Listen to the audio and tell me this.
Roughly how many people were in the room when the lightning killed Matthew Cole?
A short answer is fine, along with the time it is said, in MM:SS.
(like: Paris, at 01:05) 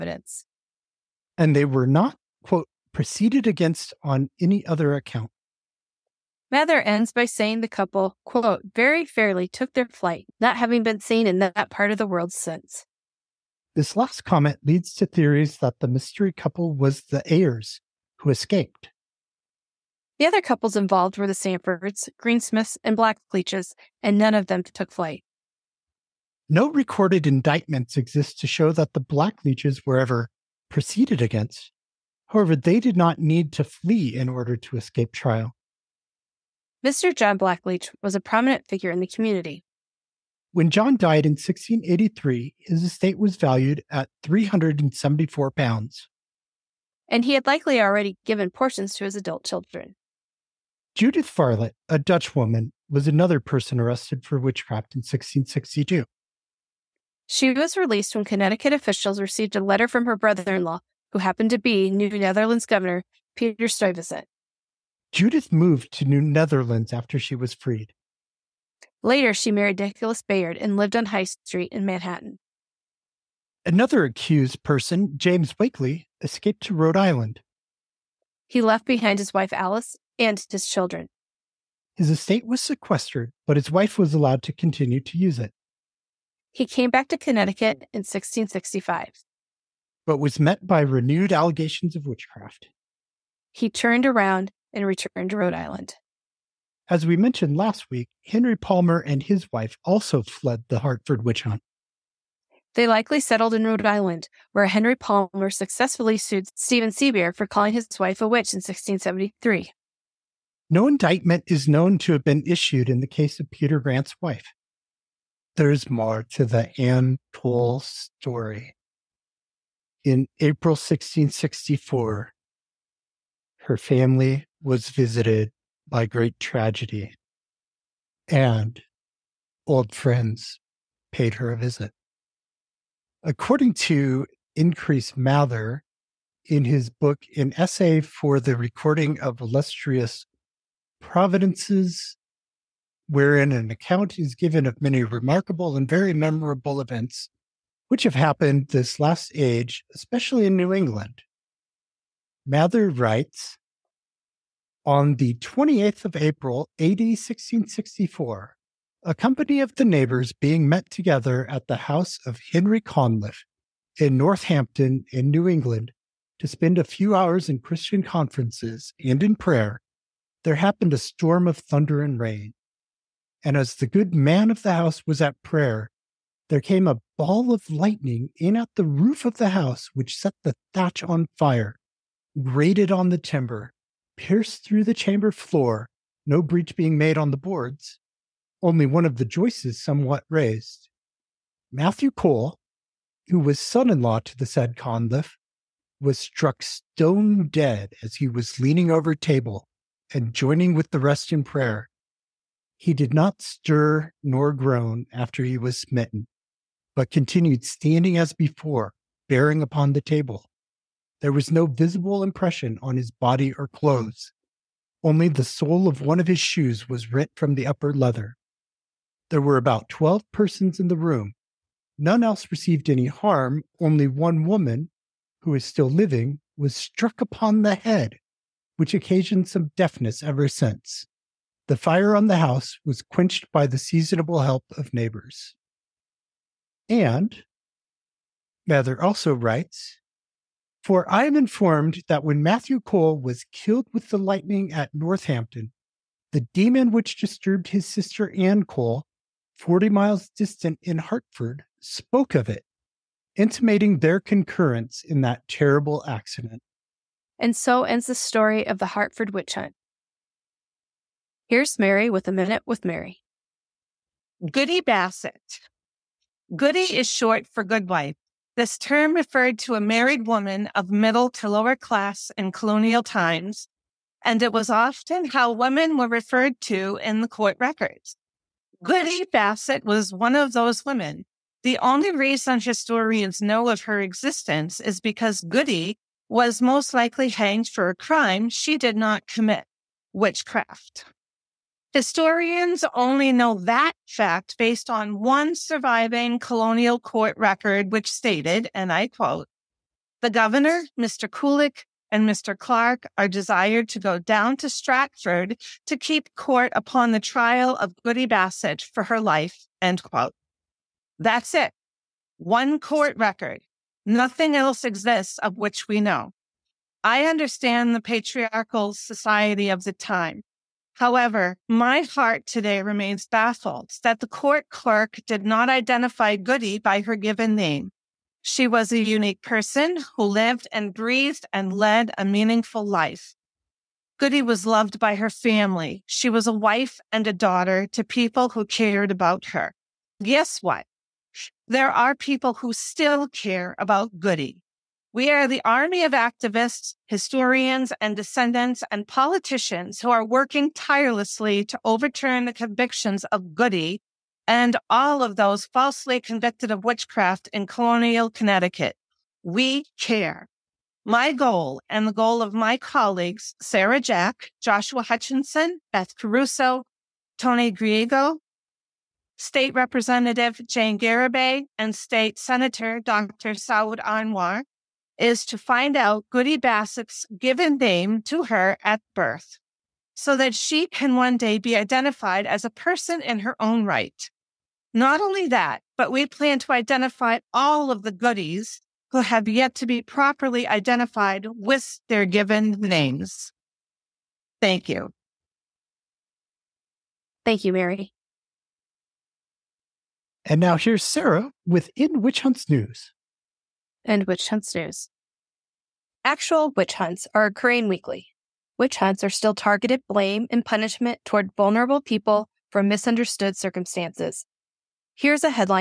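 12, at 03:39.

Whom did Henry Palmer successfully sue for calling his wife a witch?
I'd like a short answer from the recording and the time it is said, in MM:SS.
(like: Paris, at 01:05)
Stephen Seabear, at 01:46.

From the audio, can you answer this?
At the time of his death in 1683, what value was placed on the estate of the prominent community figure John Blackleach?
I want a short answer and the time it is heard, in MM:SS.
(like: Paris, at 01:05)
374 pounds, at 00:44.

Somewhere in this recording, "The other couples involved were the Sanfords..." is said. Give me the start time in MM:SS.
00:20.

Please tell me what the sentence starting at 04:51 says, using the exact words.
Historians only know that fact based on one surviving colonial court record, which stated, and I quote, the governor, Mr.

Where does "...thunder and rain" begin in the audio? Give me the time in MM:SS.
02:51.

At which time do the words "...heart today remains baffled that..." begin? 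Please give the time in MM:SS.
05:22.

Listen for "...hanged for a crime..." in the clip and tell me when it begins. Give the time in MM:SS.
04:47.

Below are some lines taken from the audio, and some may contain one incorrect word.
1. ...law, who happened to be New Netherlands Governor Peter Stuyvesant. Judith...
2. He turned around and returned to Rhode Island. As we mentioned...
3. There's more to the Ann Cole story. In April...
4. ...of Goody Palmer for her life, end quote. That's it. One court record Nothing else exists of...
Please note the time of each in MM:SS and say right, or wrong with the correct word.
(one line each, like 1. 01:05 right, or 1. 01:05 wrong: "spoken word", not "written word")
1. 01:00 right
2. 01:33 right
3. 01:55 right
4. 05:07 wrong: "Bassett", not "Palmer".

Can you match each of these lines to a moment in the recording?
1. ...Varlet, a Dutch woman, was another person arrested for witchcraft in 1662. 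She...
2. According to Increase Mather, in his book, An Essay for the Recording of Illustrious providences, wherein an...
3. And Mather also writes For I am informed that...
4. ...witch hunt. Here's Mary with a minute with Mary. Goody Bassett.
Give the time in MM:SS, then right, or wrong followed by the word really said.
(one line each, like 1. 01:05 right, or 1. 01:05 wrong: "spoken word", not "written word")
1. 00:51 right
2. 02:13 right
3. 03:56 right
4. 04:19 right.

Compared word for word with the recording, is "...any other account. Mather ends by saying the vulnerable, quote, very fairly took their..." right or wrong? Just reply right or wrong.
wrong.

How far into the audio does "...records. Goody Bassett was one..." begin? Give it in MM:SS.
04:37.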